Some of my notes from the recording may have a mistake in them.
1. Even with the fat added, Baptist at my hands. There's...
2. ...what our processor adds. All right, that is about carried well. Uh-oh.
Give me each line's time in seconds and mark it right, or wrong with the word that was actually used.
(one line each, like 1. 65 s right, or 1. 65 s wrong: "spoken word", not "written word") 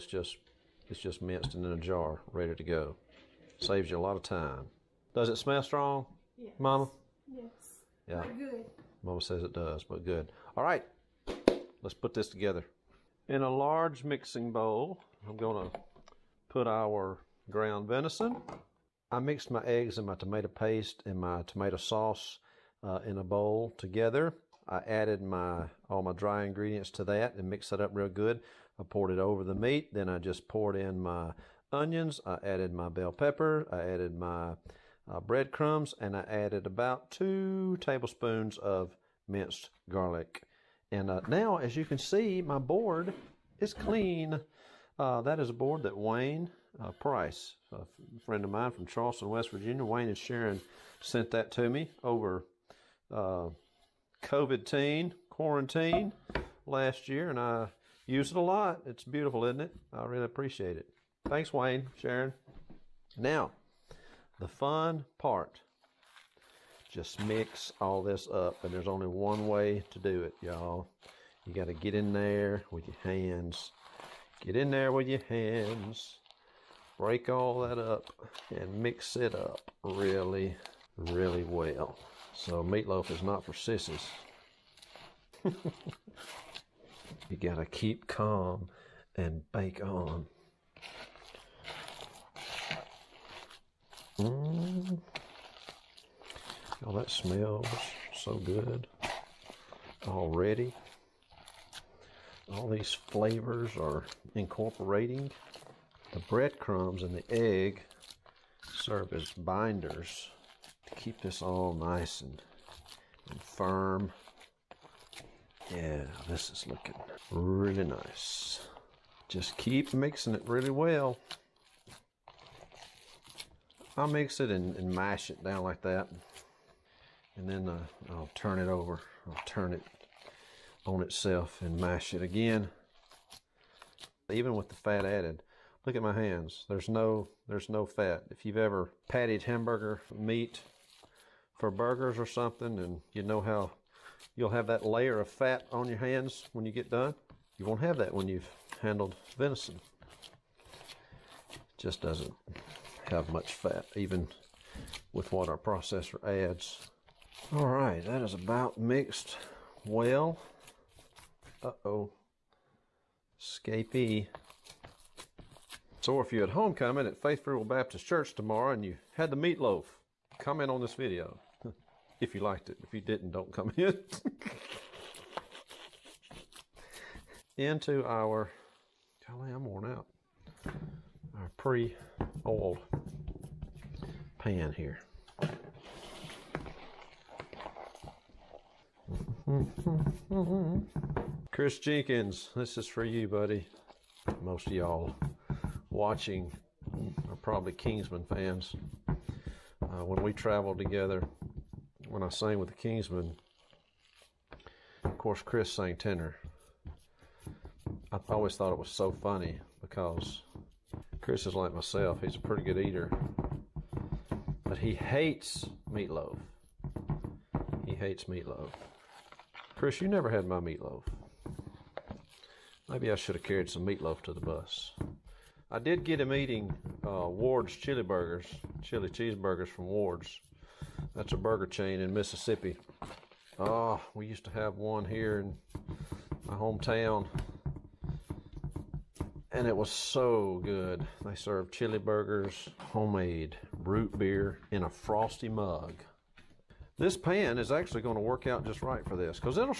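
1. 134 s wrong: "Look", not "Baptist"
2. 155 s wrong: "mixed", not "carried".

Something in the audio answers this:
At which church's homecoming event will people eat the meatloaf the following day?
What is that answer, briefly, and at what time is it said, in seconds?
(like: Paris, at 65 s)
Faith Free Will Baptist Church, at 167 s.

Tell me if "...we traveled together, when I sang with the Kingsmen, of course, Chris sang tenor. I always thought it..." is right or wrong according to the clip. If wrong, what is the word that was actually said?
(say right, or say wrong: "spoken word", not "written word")
right.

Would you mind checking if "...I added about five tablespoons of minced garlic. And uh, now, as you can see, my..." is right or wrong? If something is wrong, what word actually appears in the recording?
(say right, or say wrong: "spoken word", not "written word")
wrong: "two", not "five".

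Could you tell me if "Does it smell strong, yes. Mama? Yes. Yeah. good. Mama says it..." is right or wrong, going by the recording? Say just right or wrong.
right.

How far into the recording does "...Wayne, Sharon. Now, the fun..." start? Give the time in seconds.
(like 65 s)
61 s.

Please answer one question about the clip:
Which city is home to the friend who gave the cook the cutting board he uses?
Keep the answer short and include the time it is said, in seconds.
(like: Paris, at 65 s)
Charleston, West Virginia, at 48 s.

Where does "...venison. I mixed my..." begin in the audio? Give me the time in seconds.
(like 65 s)
17 s.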